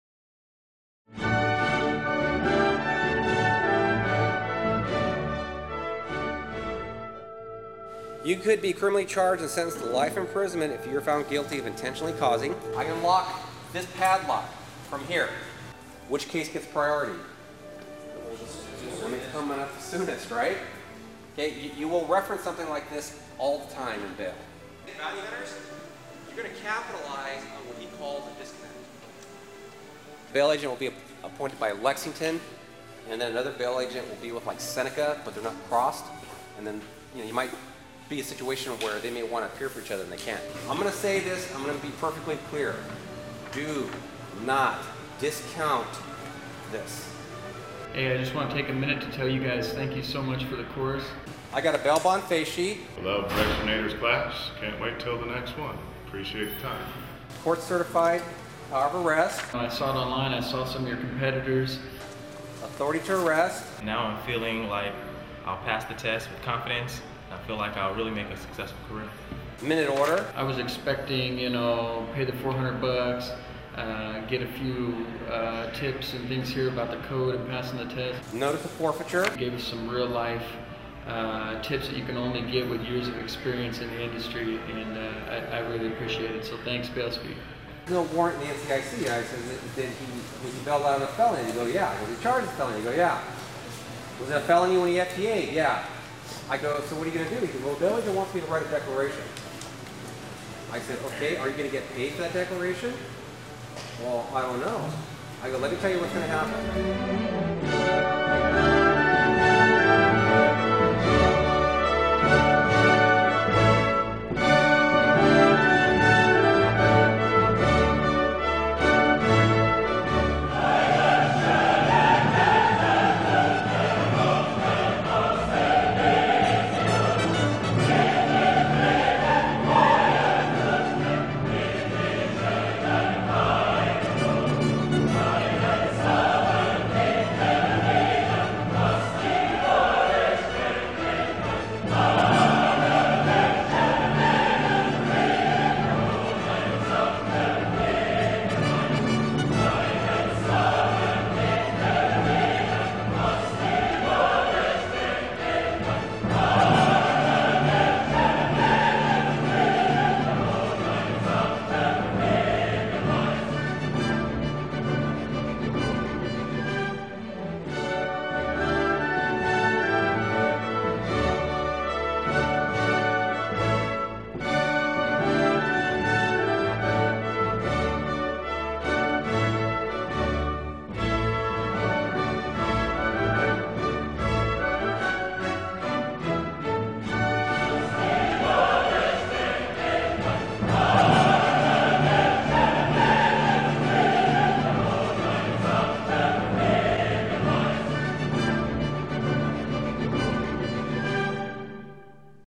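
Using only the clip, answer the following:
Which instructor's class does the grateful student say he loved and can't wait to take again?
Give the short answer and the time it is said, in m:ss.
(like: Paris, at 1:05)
Rex Venator, at 0:53.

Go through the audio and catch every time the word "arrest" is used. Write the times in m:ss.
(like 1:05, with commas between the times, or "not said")
0:59, 1:03.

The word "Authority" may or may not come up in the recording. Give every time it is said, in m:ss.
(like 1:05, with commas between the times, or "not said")
1:02.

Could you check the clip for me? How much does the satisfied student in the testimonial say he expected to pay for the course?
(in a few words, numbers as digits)
$400.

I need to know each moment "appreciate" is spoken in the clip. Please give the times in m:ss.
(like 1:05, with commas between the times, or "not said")
0:56, 1:25.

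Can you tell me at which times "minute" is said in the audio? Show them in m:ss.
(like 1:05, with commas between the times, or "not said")
0:48, 1:09.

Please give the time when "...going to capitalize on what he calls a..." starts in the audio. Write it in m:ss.
0:26.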